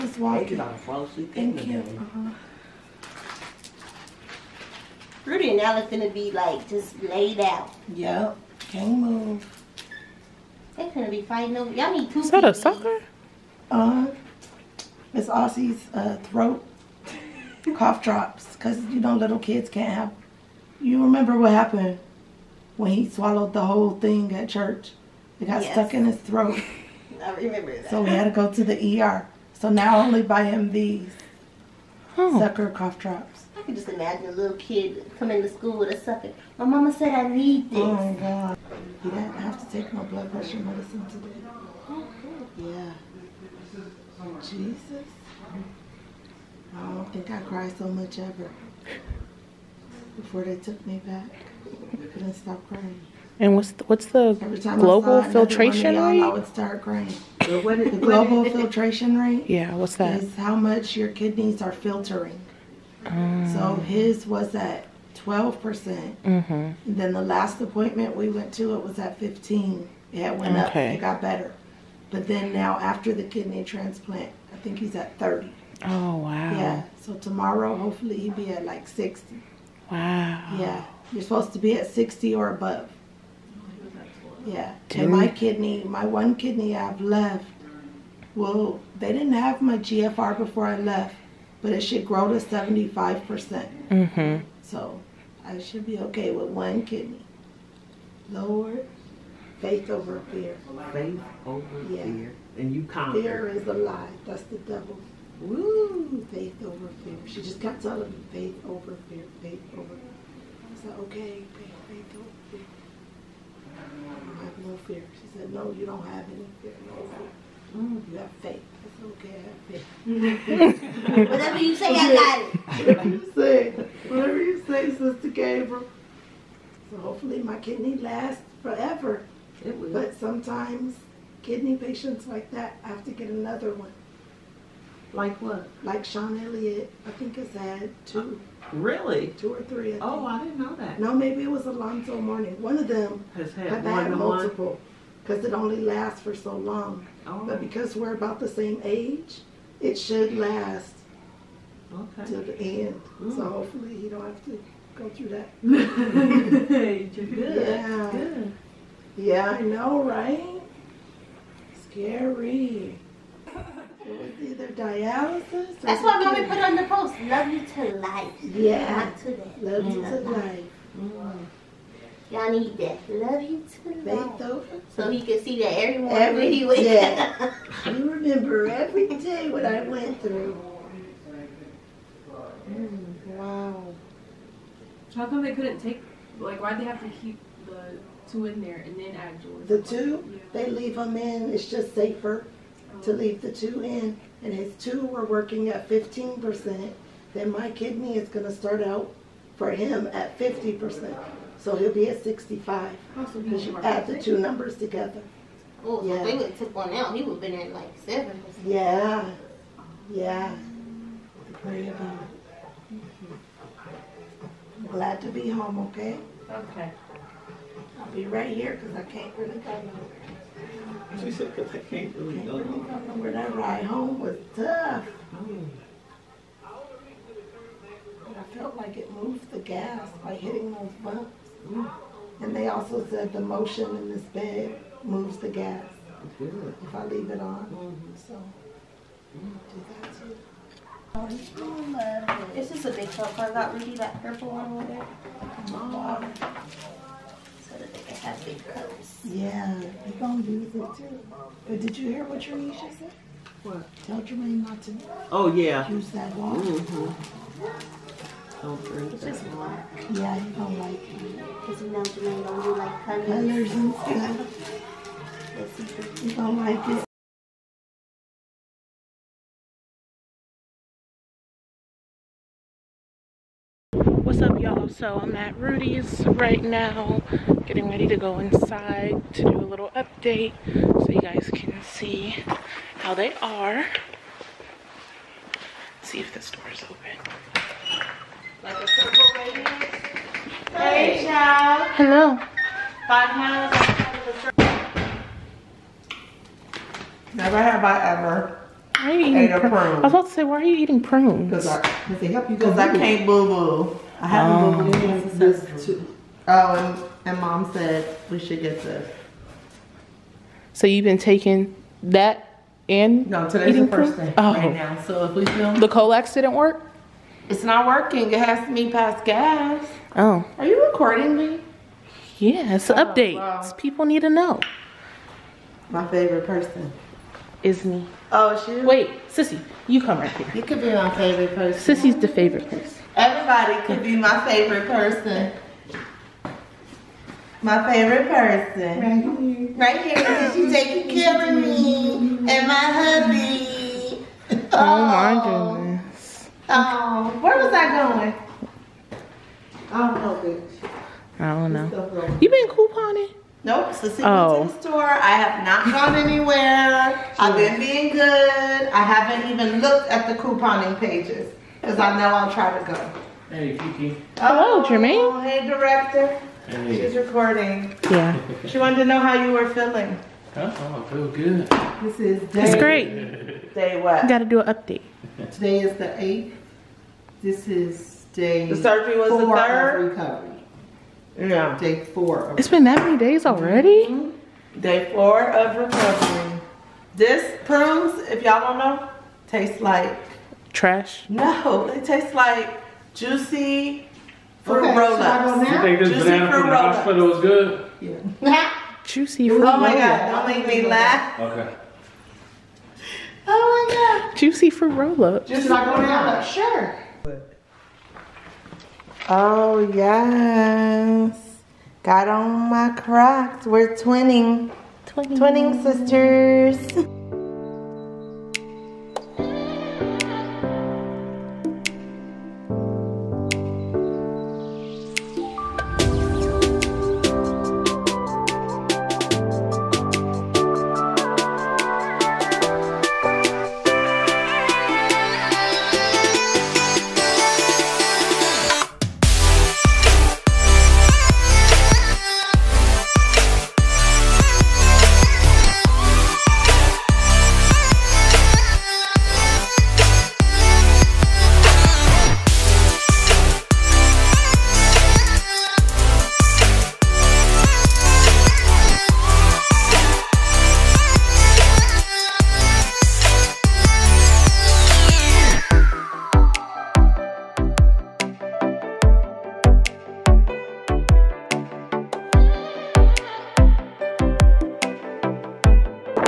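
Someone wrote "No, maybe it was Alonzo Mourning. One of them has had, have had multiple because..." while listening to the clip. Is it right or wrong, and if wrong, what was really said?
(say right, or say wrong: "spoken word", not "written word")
right.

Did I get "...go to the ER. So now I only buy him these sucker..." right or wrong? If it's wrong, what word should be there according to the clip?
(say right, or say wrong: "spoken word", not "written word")
right.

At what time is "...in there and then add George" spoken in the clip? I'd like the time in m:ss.
3:08.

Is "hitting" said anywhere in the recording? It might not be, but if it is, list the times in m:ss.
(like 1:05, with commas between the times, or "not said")
3:50.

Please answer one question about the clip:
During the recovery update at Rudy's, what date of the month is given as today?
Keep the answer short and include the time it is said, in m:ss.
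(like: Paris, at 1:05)
8th, at 6:15.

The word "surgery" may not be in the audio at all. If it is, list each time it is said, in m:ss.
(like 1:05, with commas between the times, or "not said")
6:18.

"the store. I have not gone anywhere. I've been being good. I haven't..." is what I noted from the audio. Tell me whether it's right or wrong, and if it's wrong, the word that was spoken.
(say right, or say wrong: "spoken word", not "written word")
right.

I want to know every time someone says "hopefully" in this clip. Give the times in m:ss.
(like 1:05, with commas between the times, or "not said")
1:17, 2:06, 2:33.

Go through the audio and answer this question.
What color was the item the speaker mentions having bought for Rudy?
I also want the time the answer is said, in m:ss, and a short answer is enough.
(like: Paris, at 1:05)
Purple, at 4:04.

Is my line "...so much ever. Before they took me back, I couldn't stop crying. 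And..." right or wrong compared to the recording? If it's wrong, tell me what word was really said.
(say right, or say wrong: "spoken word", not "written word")
right.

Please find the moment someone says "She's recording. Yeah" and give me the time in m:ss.
6:07.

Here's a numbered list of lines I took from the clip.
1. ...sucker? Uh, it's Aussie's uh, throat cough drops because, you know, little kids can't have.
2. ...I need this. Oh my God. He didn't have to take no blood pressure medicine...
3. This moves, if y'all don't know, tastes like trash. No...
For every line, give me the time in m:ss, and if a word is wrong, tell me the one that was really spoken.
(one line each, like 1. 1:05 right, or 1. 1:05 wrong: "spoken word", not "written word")
1. 0:12 right
2. 0:37 right
3. 6:27 wrong: "prunes", not "moves".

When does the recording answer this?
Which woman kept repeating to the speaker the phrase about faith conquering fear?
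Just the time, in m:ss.
2:04.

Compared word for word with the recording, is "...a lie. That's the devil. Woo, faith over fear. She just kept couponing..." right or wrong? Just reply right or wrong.
wrong.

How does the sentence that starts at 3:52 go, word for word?
And they also said the motion in this bed moves the gas.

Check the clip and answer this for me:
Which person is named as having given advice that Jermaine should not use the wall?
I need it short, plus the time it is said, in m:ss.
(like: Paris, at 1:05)
Trinisha, at 4:12.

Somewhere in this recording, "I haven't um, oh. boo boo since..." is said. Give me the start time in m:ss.
5:04.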